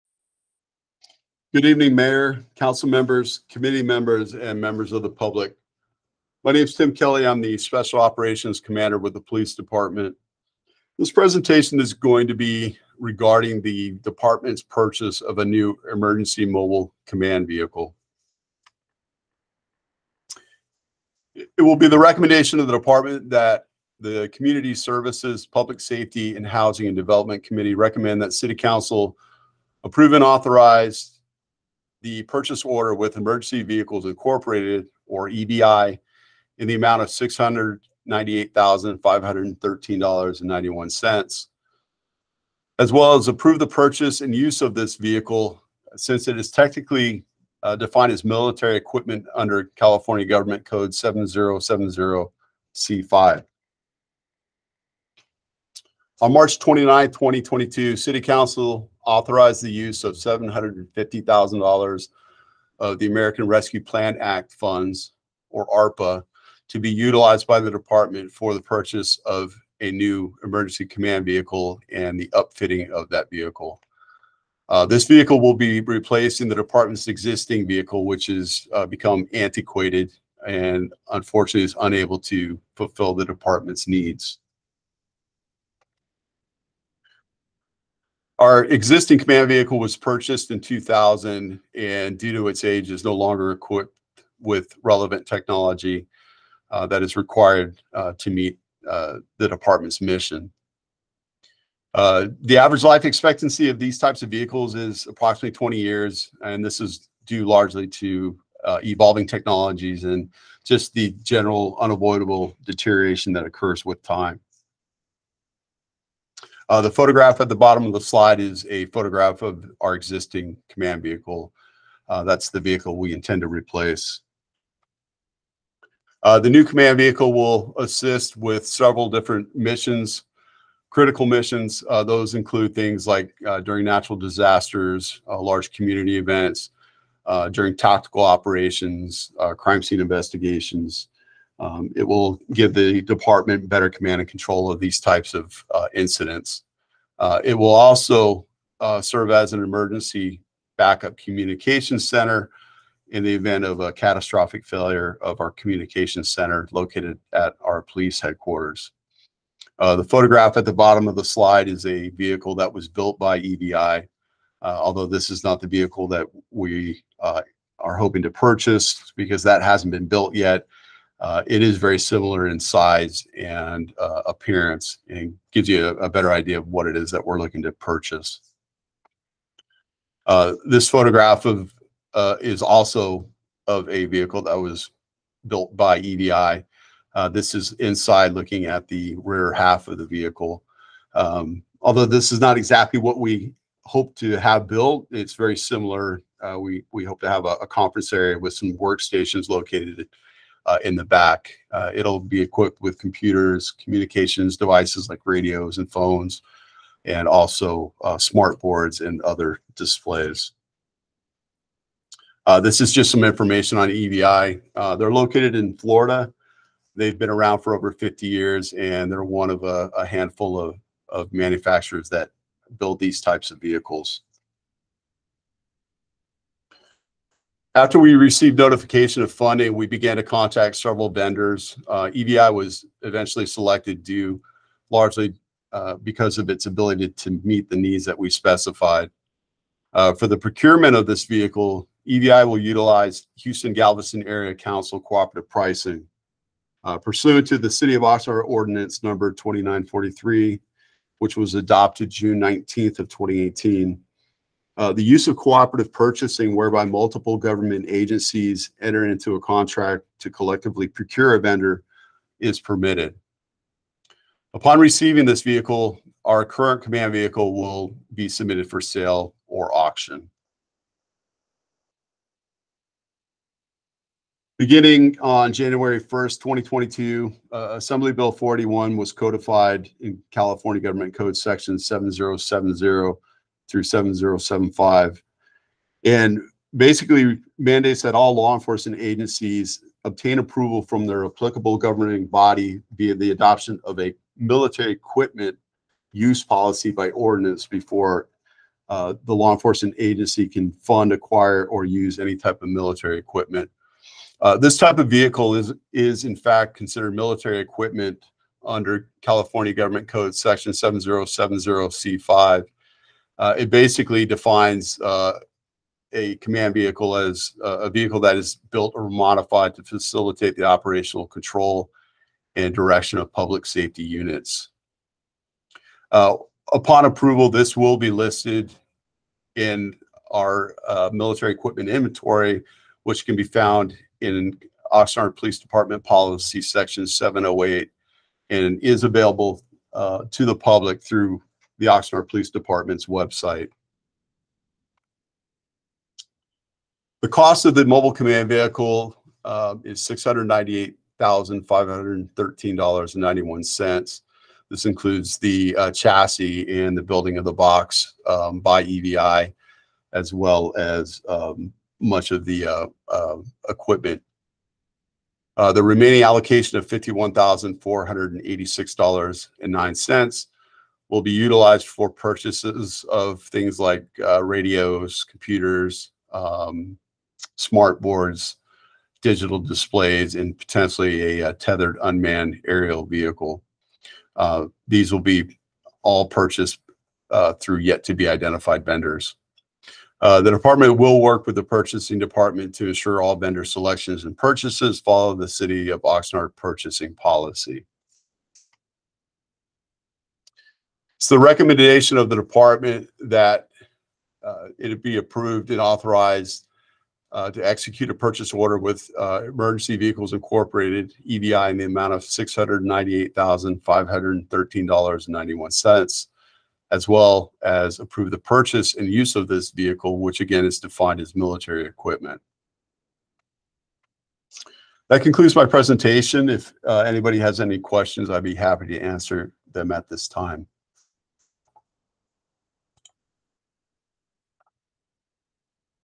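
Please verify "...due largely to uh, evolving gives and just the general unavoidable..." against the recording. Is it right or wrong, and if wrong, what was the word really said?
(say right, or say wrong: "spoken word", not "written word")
wrong: "technologies", not "gives".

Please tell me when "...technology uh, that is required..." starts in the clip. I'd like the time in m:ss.
1:35.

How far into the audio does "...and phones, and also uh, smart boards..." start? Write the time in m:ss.
3:25.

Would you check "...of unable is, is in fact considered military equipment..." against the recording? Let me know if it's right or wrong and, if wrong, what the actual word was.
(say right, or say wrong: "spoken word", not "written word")
wrong: "vehicle", not "unable".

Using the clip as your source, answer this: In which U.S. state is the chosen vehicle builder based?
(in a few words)
Florida.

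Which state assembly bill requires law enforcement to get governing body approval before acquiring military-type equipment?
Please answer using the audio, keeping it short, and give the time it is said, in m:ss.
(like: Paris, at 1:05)
Assembly Bill 41, at 4:37.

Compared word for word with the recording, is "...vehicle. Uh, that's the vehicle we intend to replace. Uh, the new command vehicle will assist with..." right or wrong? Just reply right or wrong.
right.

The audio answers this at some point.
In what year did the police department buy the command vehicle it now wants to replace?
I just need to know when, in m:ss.
1:30.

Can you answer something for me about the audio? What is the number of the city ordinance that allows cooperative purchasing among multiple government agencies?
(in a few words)
2943.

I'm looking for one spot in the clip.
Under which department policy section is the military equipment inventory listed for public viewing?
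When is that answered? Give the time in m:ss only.
5:36.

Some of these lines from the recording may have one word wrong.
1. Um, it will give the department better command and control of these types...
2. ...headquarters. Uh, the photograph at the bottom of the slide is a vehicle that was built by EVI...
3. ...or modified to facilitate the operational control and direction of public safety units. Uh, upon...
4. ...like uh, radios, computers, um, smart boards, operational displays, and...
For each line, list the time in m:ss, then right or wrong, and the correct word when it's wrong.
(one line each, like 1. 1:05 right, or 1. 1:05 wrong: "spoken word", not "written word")
1. 2:21 right
2. 2:38 right
3. 5:18 right
4. 6:13 wrong: "digital", not "operational".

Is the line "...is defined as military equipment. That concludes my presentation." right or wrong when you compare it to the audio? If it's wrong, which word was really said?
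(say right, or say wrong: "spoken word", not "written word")
right.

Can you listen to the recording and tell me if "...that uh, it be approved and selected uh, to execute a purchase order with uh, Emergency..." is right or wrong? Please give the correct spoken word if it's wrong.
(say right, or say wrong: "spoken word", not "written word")
wrong: "authorized", not "selected".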